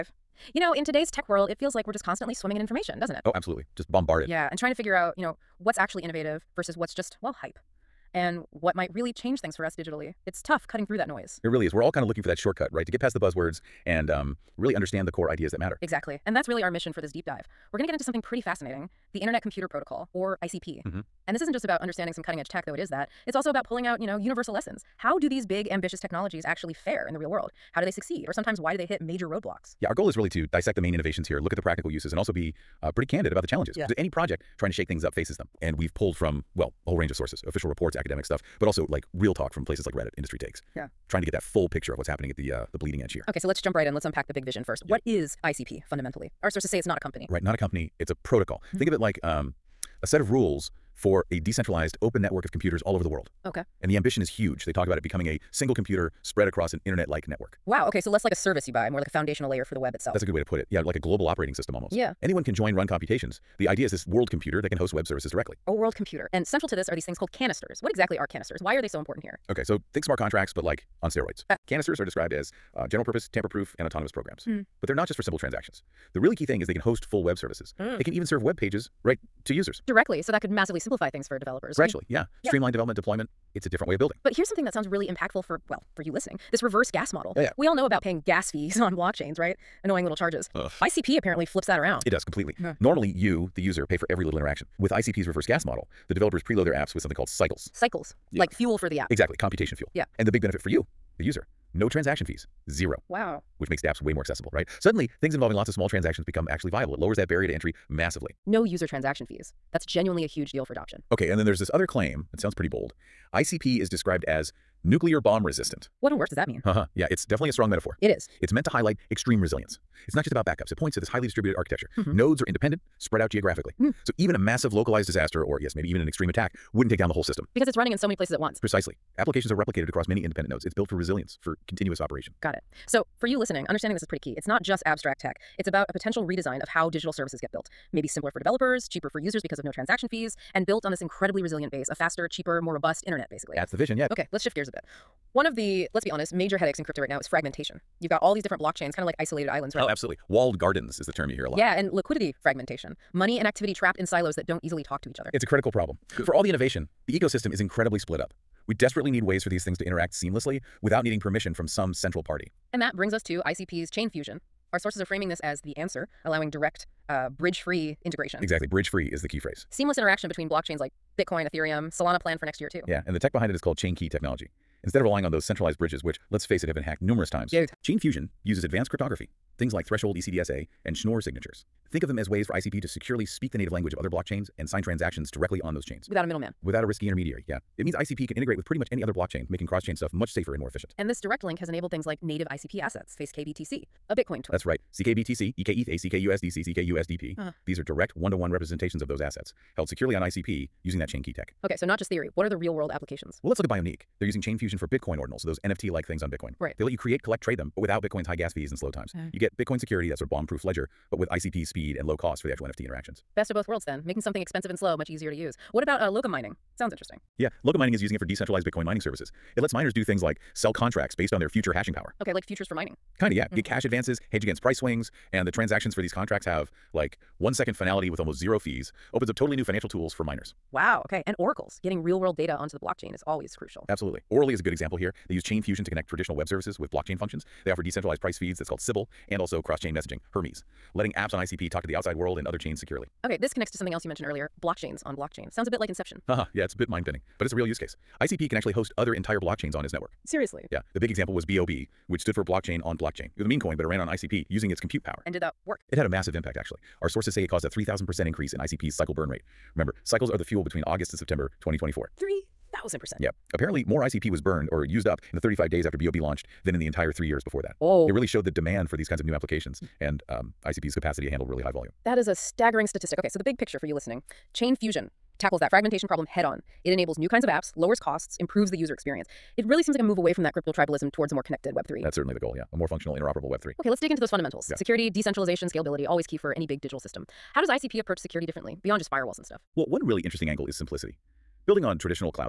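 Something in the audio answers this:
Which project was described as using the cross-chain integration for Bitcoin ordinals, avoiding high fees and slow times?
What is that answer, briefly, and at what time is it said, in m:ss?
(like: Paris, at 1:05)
Bioniq, at 3:23.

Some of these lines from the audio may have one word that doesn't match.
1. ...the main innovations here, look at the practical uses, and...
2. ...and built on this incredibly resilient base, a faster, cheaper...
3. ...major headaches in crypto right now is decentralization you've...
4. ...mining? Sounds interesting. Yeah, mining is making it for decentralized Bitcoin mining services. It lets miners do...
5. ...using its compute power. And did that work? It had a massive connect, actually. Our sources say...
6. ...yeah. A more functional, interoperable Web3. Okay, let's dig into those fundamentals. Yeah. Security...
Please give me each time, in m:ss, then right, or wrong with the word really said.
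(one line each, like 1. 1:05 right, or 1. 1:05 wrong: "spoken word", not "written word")
1. 0:30 right
2. 2:20 right
3. 2:26 wrong: "fragmentation", not "decentralization"
4. 3:36 wrong: "using", not "making"
5. 4:14 wrong: "impact", not "connect"
6. 4:42 right.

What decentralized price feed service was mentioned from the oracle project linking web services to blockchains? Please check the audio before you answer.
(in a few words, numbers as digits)
Sybil.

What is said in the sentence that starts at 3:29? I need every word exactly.
You get Bitcoin security, that sort of bomb-proof ledger, but with ICP speed and low cost for the actual NFT interactions.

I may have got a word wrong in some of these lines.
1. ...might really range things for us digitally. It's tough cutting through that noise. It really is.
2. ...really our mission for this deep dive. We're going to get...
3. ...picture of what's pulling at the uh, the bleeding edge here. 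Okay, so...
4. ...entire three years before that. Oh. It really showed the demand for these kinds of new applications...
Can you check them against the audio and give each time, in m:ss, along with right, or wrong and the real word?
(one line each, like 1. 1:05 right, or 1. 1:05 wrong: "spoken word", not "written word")
1. 0:08 wrong: "change", not "range"
2. 0:16 right
3. 0:41 wrong: "happening", not "pulling"
4. 4:26 right.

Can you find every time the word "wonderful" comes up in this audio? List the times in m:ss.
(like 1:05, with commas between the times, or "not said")
not said.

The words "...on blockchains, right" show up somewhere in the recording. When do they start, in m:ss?
1:28.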